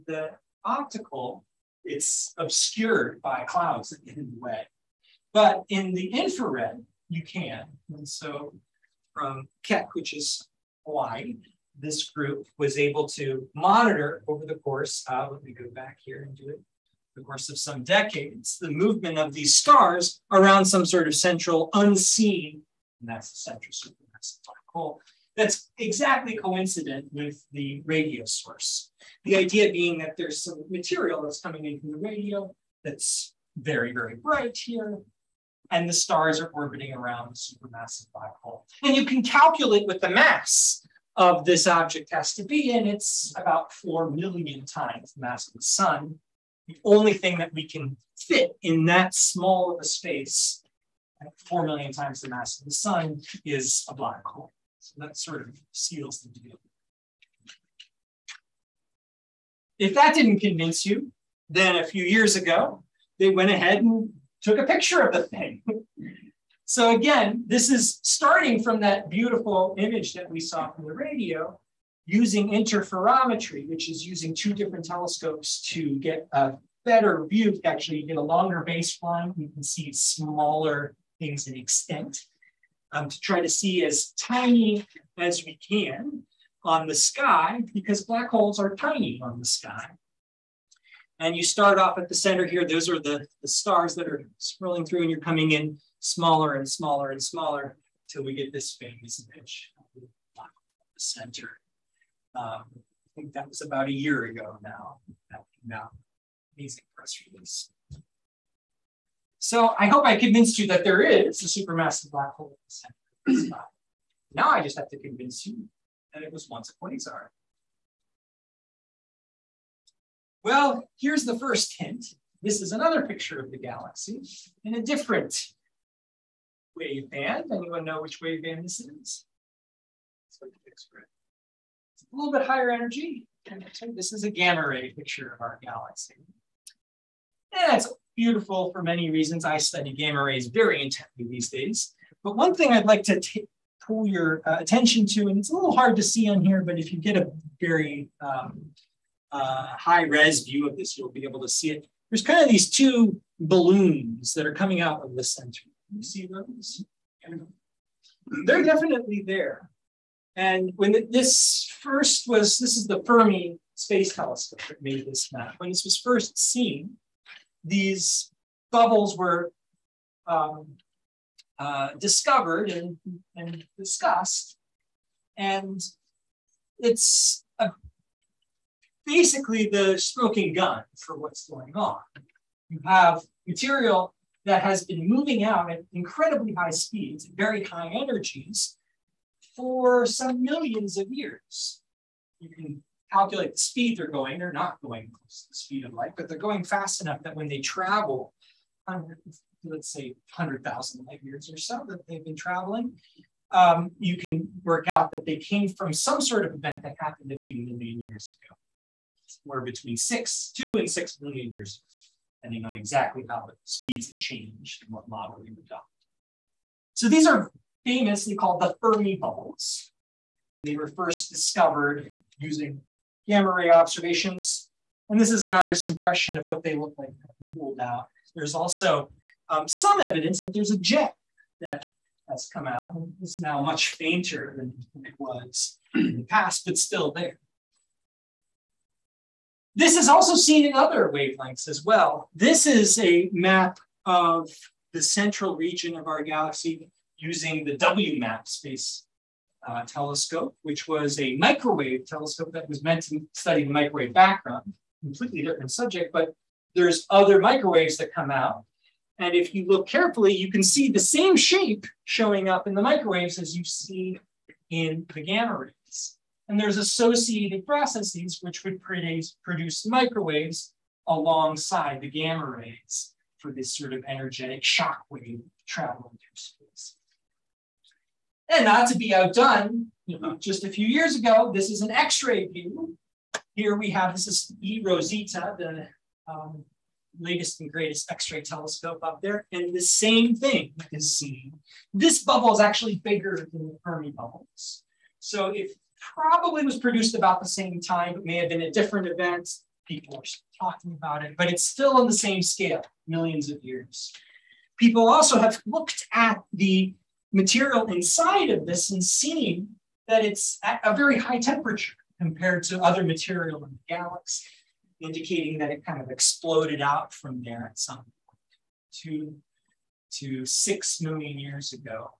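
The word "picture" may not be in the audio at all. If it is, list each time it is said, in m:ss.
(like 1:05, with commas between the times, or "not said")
1:04, 2:03, 2:14.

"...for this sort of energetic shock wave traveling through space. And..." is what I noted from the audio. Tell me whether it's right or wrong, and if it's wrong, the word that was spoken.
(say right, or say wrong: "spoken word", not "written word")
right.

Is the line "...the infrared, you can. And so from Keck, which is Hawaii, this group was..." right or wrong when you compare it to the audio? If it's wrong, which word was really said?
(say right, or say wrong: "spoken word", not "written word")
right.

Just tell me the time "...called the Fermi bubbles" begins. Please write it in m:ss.
3:38.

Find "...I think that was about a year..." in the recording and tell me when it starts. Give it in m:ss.
1:42.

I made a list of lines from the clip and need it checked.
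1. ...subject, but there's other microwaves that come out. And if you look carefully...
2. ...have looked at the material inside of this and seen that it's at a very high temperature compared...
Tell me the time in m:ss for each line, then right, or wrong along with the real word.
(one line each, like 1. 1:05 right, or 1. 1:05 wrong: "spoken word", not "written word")
1. 4:15 right
2. 5:05 right.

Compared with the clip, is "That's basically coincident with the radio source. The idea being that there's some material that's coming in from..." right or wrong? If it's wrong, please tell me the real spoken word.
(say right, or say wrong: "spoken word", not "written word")
wrong: "exactly", not "basically".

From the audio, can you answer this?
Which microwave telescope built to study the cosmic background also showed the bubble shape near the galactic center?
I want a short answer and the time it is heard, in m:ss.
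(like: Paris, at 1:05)
WMAP, at 4:07.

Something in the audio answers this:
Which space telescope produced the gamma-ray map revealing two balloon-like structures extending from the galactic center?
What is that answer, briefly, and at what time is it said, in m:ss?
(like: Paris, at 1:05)
Fermi Space Telescope, at 2:43.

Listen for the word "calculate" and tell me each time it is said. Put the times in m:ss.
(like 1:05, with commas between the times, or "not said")
0:39, 3:13.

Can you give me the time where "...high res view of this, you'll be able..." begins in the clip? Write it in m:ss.
2:29.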